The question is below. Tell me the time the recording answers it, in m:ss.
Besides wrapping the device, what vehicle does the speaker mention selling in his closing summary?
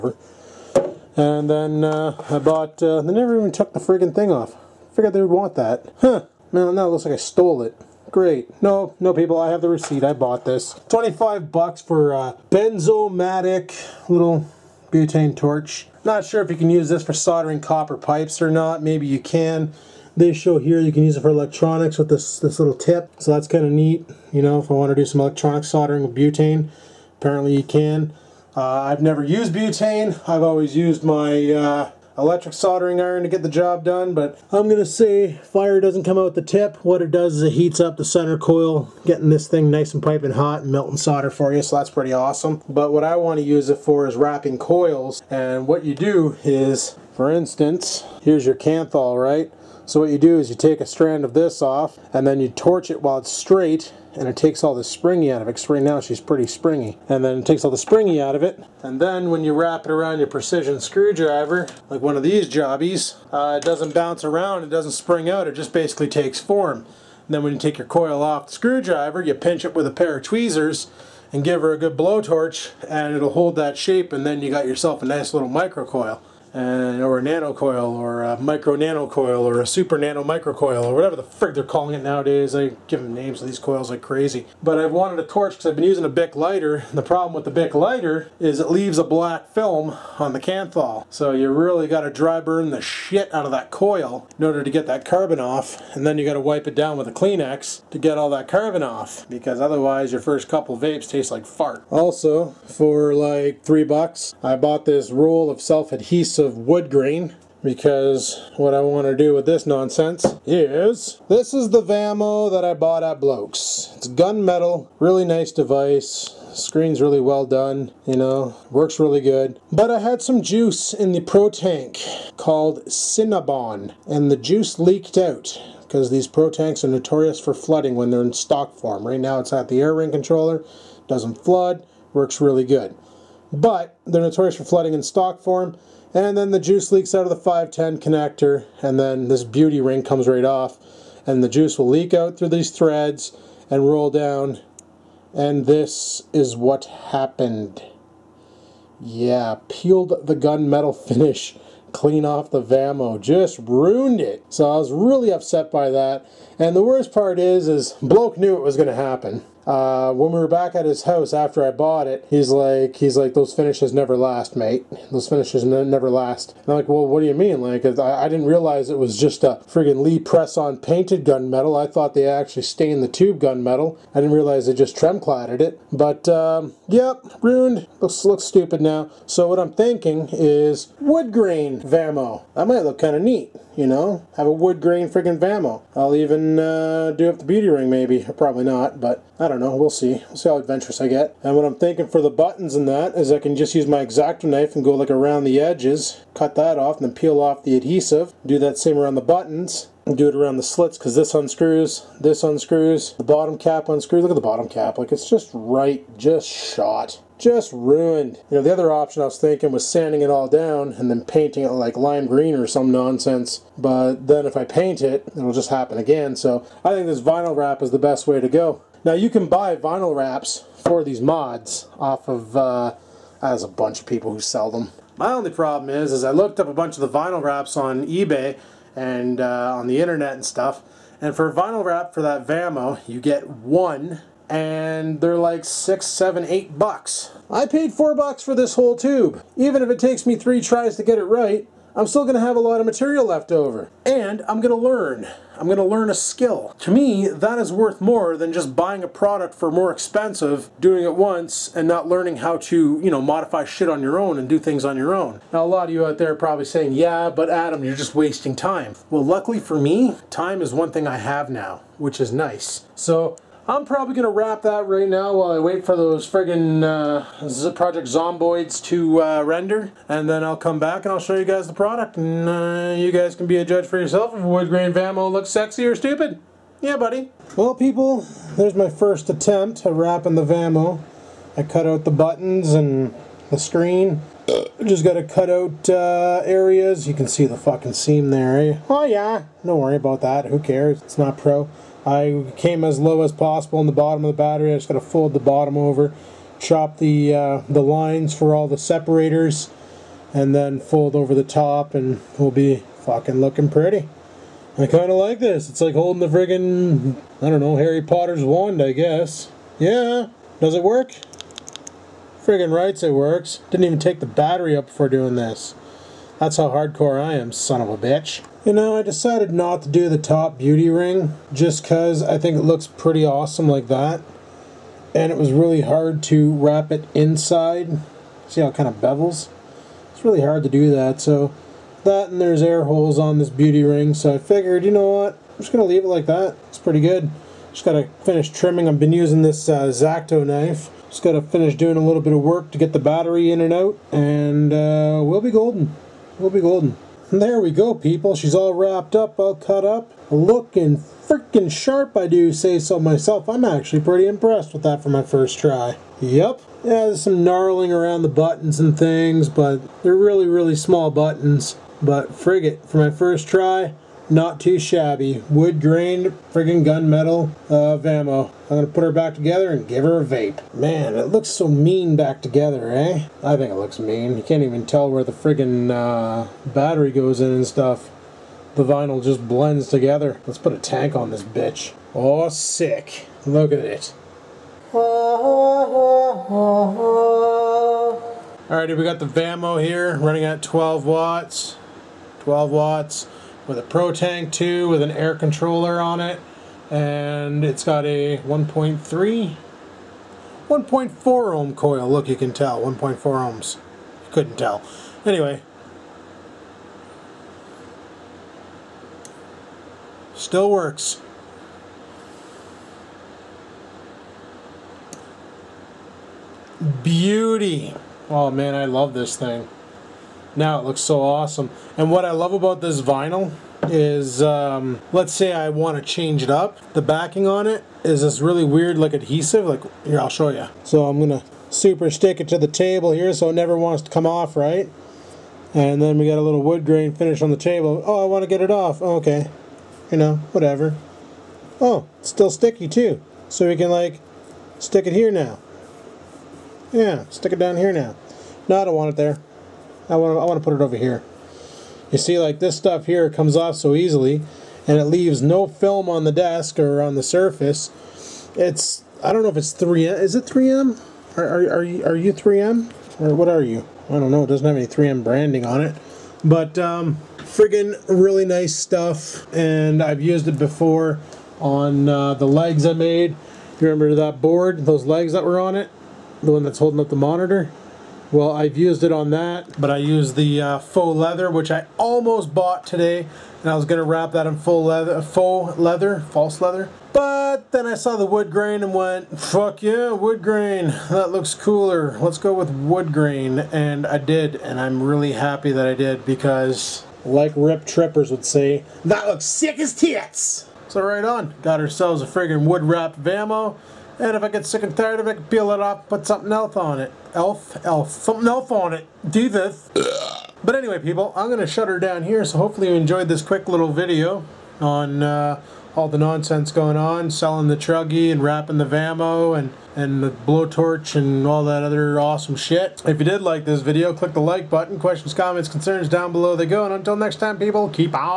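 8:37.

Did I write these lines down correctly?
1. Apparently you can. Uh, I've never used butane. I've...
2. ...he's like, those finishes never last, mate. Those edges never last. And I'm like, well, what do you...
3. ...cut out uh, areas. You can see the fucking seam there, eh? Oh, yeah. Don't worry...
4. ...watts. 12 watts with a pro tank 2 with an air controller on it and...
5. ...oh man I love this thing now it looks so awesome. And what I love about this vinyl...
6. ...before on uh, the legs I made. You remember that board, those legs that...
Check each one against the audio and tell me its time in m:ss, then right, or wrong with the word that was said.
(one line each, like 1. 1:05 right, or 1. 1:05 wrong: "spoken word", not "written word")
1. 0:27 right
2. 2:42 wrong: "finishes", not "edges"
3. 4:45 right
4. 6:31 right
5. 6:58 right
6. 7:50 right.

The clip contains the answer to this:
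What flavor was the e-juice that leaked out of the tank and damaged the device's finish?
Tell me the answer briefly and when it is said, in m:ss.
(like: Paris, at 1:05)
Cinnabon, at 2:02.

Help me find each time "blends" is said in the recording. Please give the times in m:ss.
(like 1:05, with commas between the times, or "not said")
6:19.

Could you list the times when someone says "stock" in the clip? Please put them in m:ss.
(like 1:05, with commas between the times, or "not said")
2:08, 2:15.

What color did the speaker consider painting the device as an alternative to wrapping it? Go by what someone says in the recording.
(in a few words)
Lime green.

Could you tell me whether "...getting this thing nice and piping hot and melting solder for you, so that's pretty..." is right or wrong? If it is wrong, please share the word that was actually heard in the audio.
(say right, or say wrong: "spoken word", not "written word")
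right.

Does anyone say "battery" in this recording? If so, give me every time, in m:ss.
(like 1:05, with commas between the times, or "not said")
4:54, 5:14, 5:42, 6:16.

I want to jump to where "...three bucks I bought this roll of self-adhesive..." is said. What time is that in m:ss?
1:43.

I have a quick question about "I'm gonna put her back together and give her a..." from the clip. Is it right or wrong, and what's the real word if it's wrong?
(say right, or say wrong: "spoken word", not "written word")
right.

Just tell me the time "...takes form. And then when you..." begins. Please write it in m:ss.
1:06.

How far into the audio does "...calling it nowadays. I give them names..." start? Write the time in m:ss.
1:21.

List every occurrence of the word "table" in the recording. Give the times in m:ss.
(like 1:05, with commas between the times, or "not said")
7:12, 7:17.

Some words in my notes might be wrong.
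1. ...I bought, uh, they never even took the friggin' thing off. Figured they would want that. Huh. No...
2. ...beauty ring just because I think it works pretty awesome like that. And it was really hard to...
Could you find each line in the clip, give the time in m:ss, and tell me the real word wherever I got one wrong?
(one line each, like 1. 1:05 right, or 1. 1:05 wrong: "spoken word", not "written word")
1. 0:02 right
2. 5:20 wrong: "looks", not "works".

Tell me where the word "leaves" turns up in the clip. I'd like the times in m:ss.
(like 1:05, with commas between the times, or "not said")
1:28, 5:35, 7:35.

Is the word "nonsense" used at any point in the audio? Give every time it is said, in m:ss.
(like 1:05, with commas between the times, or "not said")
1:49, 3:32, 8:36.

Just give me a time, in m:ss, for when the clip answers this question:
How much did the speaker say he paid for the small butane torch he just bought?
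0:10.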